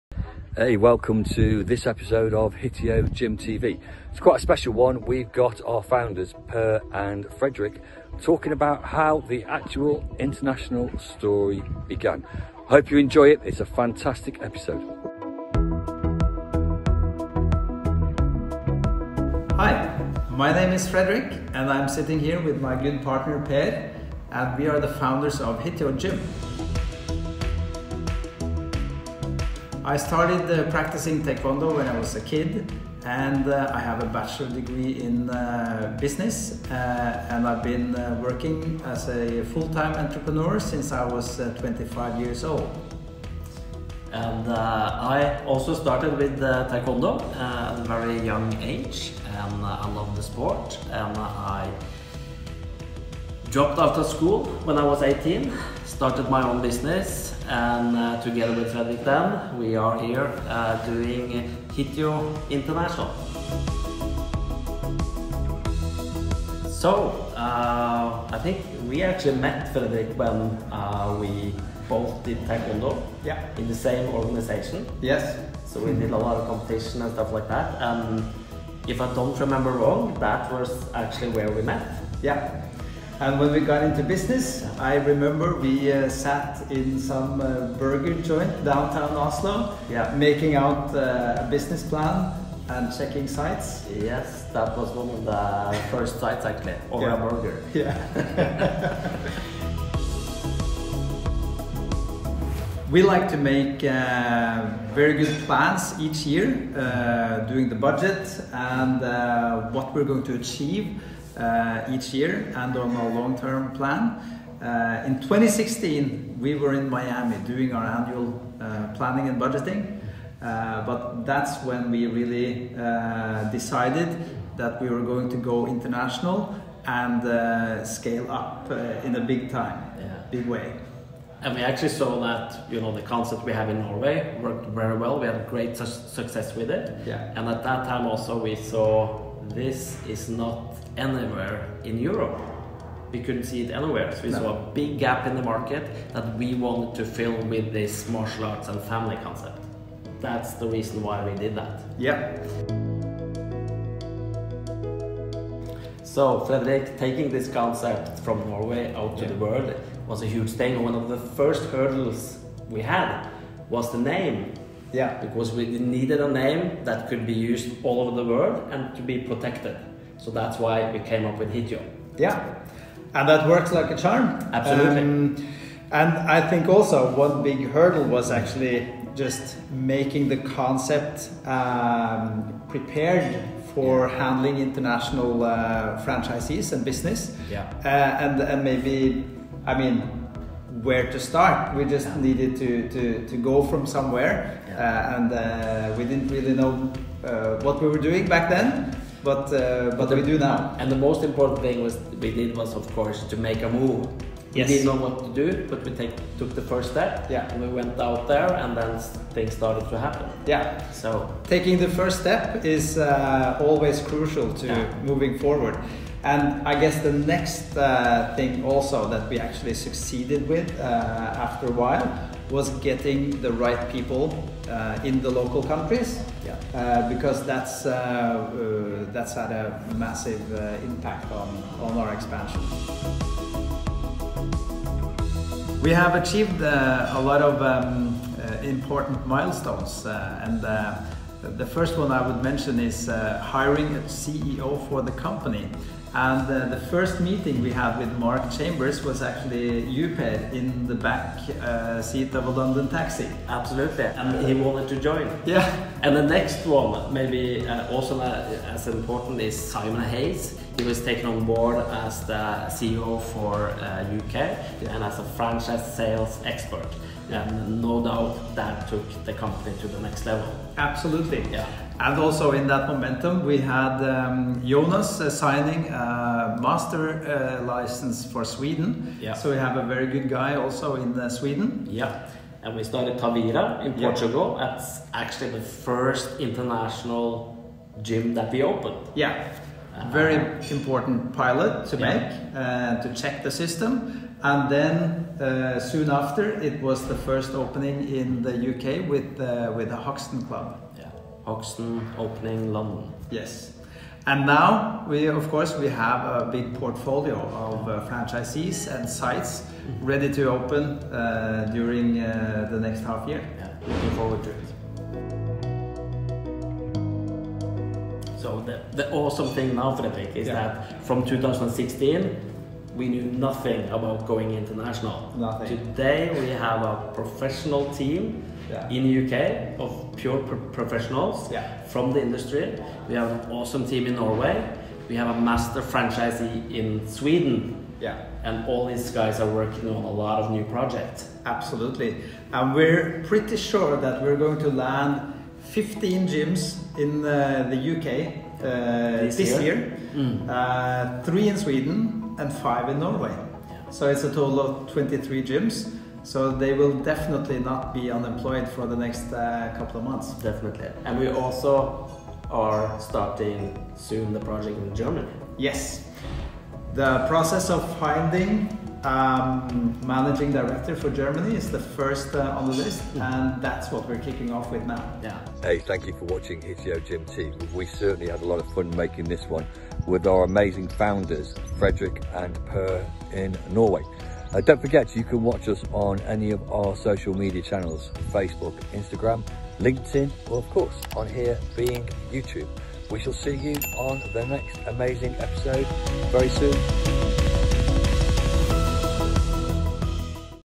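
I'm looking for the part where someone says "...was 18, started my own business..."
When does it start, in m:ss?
0:54.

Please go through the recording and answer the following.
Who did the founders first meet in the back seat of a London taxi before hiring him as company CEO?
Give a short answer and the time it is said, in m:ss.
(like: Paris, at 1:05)
Mark Chambers, at 4:08.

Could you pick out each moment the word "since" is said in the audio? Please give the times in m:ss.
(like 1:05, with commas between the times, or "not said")
0:40.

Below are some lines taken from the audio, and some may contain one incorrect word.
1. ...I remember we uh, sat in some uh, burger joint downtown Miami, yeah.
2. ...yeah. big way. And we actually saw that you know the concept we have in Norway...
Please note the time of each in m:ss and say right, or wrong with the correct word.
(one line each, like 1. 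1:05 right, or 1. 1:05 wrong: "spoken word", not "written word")
1. 1:24 wrong: "Oslo", not "Miami"
2. 2:09 right.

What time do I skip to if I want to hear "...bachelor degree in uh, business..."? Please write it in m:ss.
0:34.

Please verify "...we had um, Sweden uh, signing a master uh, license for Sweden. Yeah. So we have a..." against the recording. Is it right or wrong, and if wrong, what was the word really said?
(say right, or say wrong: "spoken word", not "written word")
wrong: "Jonas", not "Sweden".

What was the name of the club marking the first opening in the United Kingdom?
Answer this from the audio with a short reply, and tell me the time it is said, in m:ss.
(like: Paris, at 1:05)
Hoxton Club, at 4:59.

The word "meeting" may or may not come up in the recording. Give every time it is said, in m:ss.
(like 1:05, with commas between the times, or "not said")
4:07.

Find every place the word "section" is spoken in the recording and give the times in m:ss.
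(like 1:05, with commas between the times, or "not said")
not said.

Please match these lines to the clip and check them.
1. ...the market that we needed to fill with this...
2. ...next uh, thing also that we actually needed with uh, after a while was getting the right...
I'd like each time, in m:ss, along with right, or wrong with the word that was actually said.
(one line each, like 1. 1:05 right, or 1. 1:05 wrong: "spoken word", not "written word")
1. 2:25 wrong: "wanted", not "needed"
2. 3:37 wrong: "succeeded", not "needed".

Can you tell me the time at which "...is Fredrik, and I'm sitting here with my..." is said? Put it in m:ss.
0:20.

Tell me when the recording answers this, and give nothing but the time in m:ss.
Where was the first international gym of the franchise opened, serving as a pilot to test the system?
4:43.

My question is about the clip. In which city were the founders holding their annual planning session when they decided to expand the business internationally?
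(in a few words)
Miami.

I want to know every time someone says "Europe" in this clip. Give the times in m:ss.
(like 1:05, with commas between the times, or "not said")
2:21.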